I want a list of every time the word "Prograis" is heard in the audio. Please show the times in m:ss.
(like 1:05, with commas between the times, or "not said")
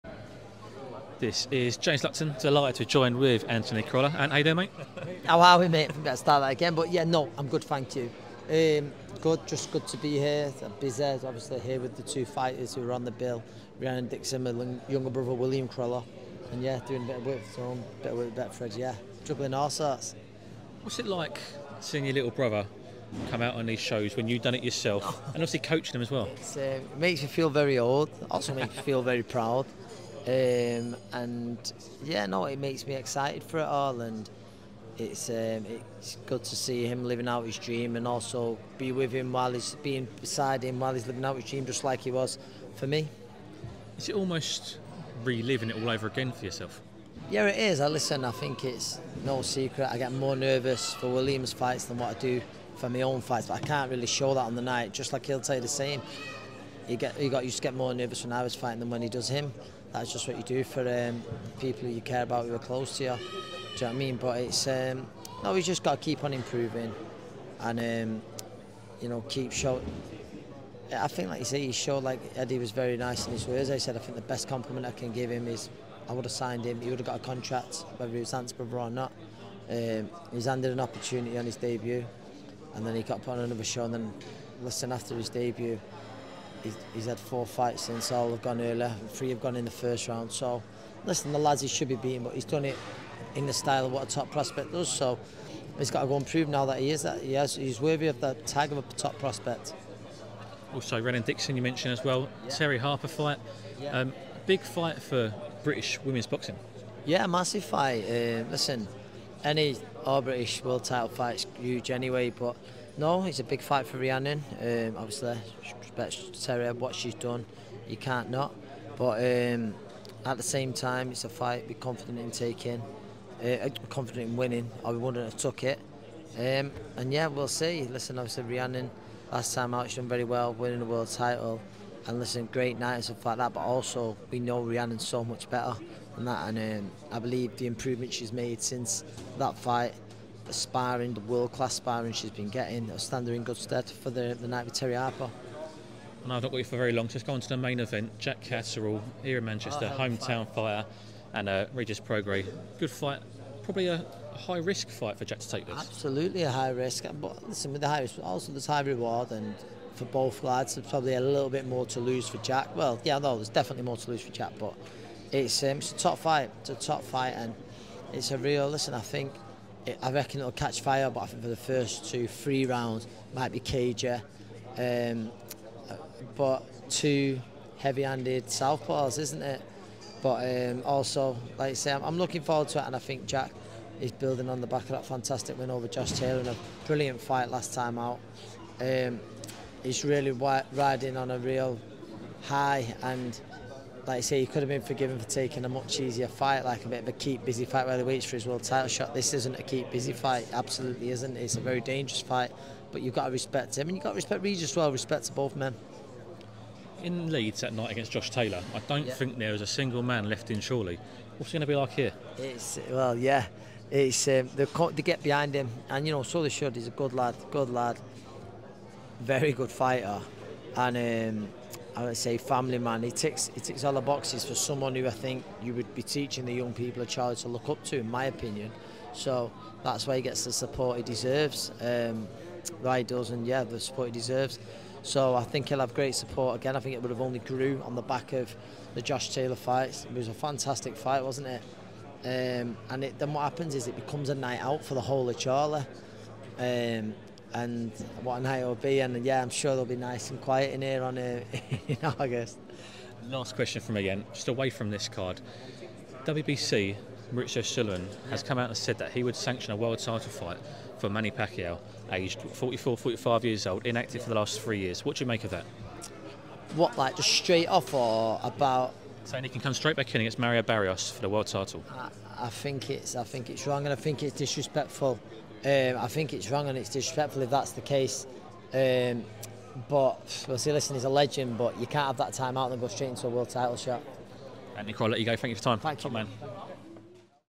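2:31.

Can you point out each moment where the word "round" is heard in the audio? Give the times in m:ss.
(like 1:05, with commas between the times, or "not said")
1:30, 2:52.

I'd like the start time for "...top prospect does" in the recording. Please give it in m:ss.
1:34.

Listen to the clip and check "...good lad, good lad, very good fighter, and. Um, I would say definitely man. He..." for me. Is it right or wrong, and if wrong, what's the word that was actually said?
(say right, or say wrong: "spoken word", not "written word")
wrong: "family", not "definitely".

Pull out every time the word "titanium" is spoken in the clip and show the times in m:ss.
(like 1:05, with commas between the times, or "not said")
not said.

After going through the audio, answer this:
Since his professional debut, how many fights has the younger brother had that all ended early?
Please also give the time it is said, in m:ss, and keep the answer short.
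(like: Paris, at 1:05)
4, at 1:27.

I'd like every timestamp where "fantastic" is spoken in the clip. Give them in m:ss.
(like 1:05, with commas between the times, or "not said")
3:05, 4:00.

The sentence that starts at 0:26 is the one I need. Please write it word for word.
Uh, it makes you feel very old, also makes you feel very proud.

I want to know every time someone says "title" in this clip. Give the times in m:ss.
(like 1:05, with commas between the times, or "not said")
1:50, 2:11, 3:18, 4:19, 4:31, 4:43.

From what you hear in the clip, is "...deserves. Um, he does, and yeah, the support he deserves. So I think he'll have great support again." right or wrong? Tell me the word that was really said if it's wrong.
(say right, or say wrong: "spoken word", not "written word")
right.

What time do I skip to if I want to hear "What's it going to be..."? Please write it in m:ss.
3:31.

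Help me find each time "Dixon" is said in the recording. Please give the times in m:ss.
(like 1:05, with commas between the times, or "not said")
0:14, 1:41.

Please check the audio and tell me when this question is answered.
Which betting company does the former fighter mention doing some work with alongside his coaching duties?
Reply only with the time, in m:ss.
0:18.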